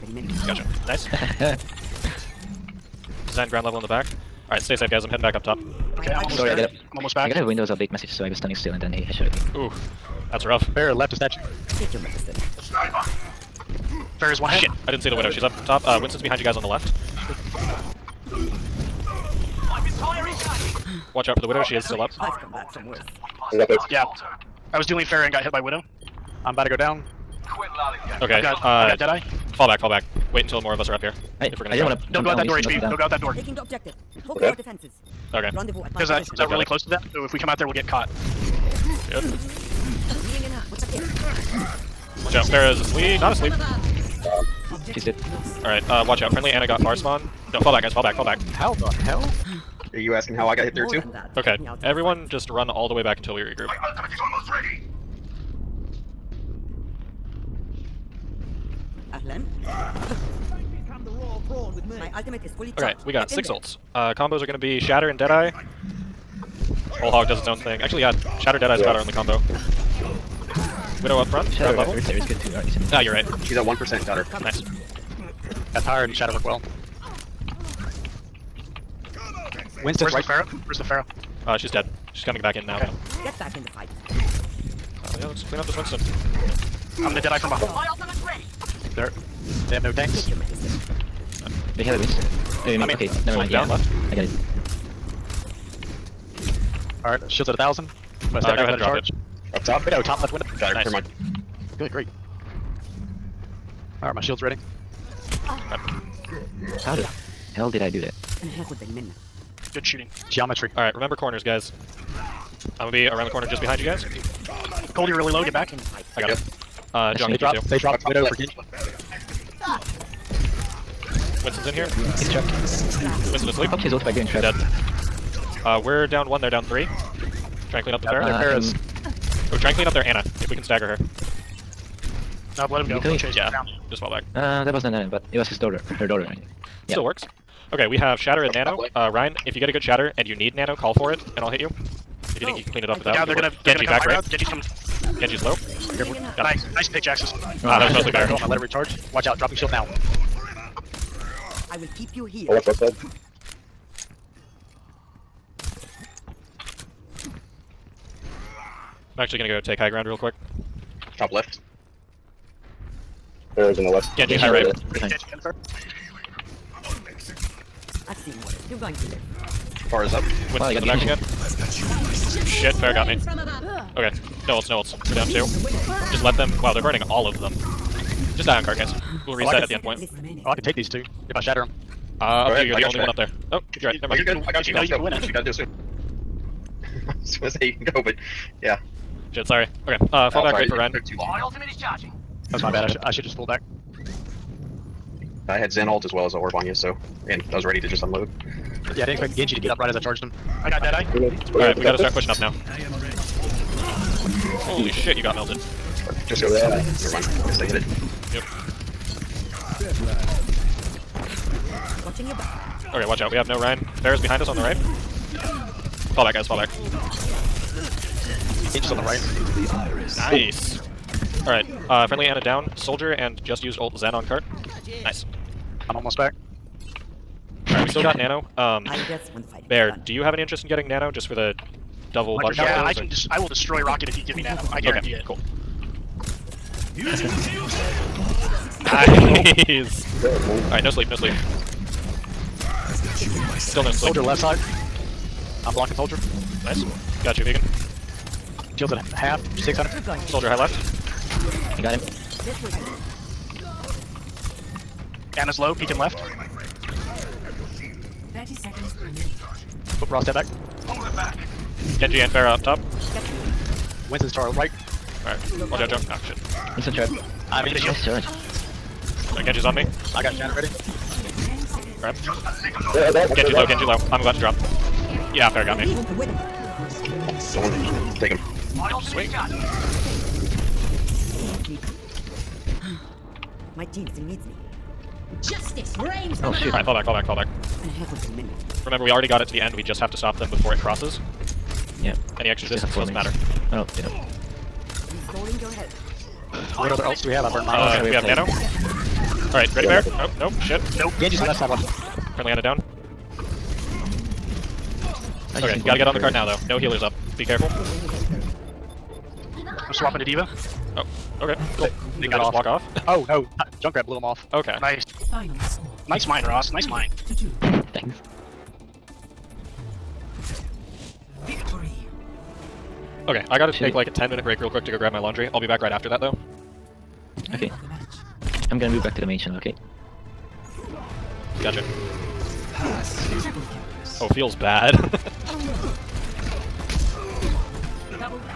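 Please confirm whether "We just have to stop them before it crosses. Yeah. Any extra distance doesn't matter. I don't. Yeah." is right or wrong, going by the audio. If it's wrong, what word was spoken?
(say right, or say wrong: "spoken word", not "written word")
right.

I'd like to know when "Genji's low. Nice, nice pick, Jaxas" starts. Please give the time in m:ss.
2:25.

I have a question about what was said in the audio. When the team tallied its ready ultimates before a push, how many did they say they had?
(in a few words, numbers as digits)
6.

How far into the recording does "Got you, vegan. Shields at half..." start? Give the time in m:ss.
4:07.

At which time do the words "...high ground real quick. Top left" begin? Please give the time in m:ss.
2:39.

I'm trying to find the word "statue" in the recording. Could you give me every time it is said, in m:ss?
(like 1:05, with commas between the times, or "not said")
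0:11.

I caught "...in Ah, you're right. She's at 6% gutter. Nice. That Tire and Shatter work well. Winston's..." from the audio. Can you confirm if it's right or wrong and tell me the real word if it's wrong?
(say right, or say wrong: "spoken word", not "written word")
wrong: "1", not "6".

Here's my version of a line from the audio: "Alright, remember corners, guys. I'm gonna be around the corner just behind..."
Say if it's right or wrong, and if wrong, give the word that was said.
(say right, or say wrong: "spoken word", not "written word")
right.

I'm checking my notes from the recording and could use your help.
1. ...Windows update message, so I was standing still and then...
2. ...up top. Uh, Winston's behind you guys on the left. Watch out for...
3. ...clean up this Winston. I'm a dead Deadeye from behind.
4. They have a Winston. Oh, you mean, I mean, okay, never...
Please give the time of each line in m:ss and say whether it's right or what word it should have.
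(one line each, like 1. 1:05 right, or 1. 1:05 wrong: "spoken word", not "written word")
1. 0:07 right
2. 0:15 right
3. 1:25 right
4. 1:31 right.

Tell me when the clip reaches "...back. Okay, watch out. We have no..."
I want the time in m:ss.
3:32.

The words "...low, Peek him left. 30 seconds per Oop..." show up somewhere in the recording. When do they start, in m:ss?
4:15.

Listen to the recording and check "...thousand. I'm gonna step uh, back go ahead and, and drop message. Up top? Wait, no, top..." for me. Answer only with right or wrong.
wrong.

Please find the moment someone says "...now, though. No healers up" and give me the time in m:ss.
5:06.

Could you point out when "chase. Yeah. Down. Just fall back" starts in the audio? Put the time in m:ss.
2:13.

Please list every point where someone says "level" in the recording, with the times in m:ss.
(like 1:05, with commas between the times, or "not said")
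0:03, 1:11.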